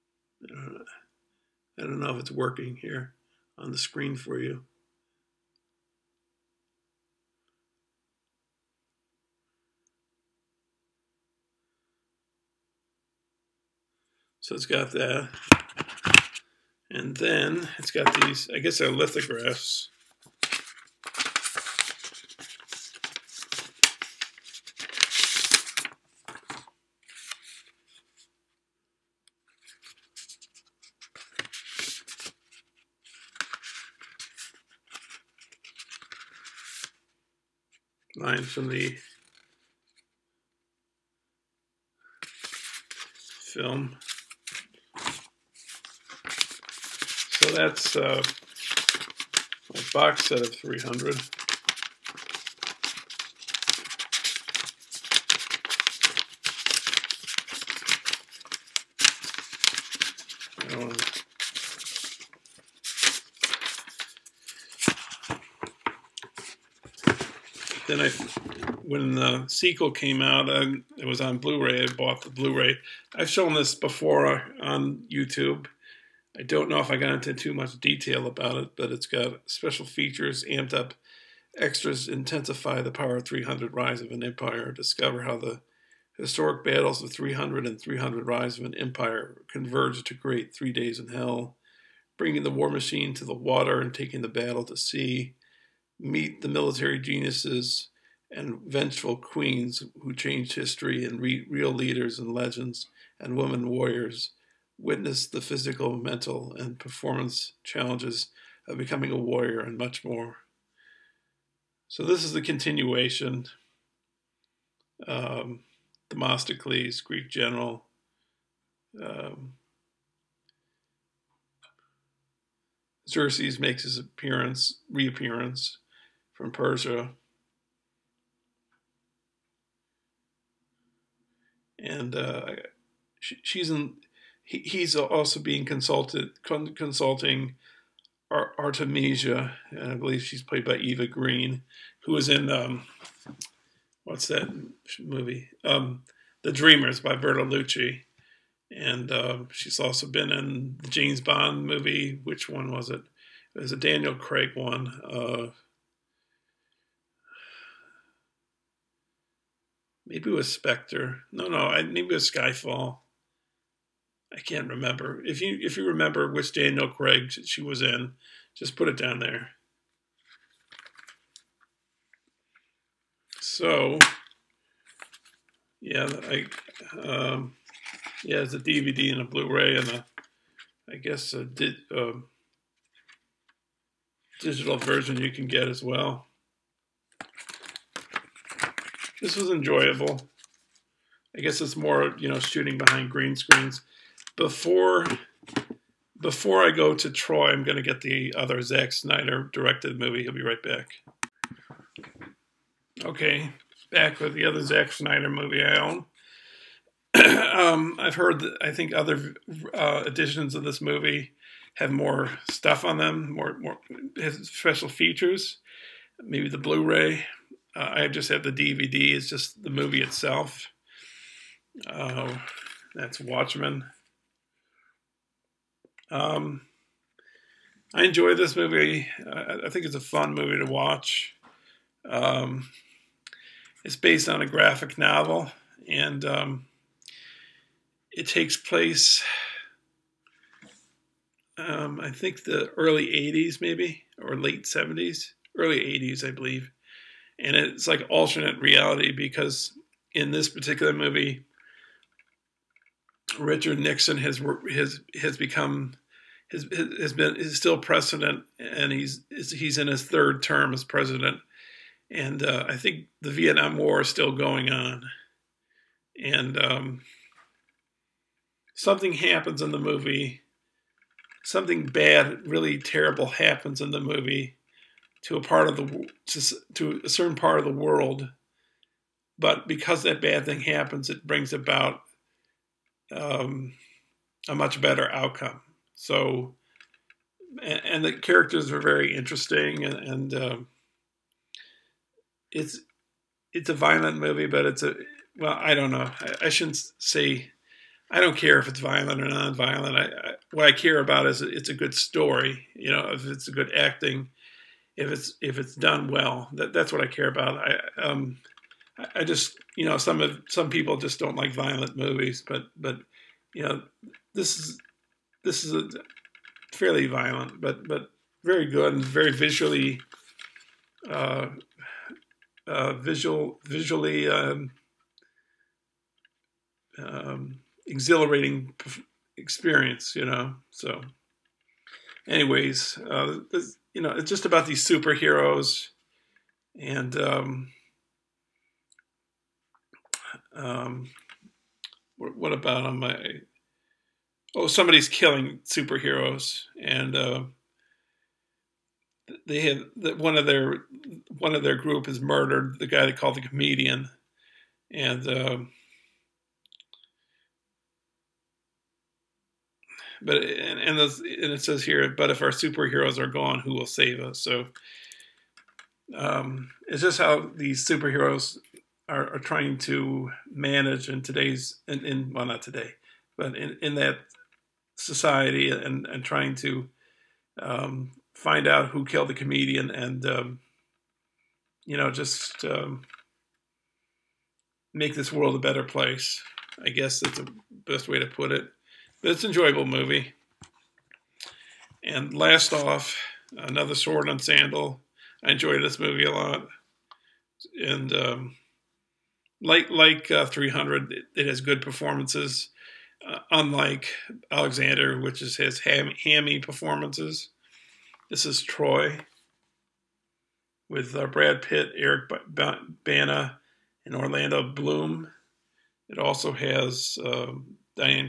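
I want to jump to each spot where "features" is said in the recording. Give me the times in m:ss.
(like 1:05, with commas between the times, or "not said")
1:19, 3:34.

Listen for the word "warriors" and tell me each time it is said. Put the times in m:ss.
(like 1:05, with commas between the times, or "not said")
1:43, 1:49.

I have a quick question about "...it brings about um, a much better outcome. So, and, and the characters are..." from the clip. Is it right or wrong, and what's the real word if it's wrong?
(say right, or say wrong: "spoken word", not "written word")
right.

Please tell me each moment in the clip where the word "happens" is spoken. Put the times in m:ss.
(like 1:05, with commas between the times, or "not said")
4:29, 4:33, 4:40.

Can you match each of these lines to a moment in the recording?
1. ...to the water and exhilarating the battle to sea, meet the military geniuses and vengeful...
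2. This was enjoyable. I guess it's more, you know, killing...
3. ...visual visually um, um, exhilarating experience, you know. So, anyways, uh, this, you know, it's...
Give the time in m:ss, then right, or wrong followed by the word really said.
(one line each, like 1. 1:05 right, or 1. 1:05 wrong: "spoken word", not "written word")
1. 1:33 wrong: "taking", not "exhilarating"
2. 3:09 wrong: "shooting", not "killing"
3. 5:22 right.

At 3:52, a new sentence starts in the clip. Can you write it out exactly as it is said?
Um, it's based on a graphic novel, and um, it takes place.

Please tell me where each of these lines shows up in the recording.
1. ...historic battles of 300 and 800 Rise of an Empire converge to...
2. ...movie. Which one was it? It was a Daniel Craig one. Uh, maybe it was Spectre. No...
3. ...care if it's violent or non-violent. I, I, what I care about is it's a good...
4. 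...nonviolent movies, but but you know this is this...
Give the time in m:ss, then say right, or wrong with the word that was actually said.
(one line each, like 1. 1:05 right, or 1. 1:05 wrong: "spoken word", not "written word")
1. 1:26 wrong: "300", not "800"
2. 2:31 right
3. 4:58 right
4. 5:11 wrong: "violent", not "nonviolent".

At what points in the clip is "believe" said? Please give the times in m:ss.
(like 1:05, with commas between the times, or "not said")
2:19, 4:06.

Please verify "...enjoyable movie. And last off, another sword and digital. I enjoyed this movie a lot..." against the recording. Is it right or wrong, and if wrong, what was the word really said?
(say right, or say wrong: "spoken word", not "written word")
wrong: "sandal", not "digital".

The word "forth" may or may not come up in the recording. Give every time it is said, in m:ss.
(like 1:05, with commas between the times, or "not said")
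not said.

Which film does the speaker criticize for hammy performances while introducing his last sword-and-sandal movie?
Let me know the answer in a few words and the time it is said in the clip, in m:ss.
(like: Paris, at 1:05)
Alexander, at 6:44.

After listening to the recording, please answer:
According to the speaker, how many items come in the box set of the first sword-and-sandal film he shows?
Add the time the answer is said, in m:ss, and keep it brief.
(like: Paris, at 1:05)
300, at 0:49.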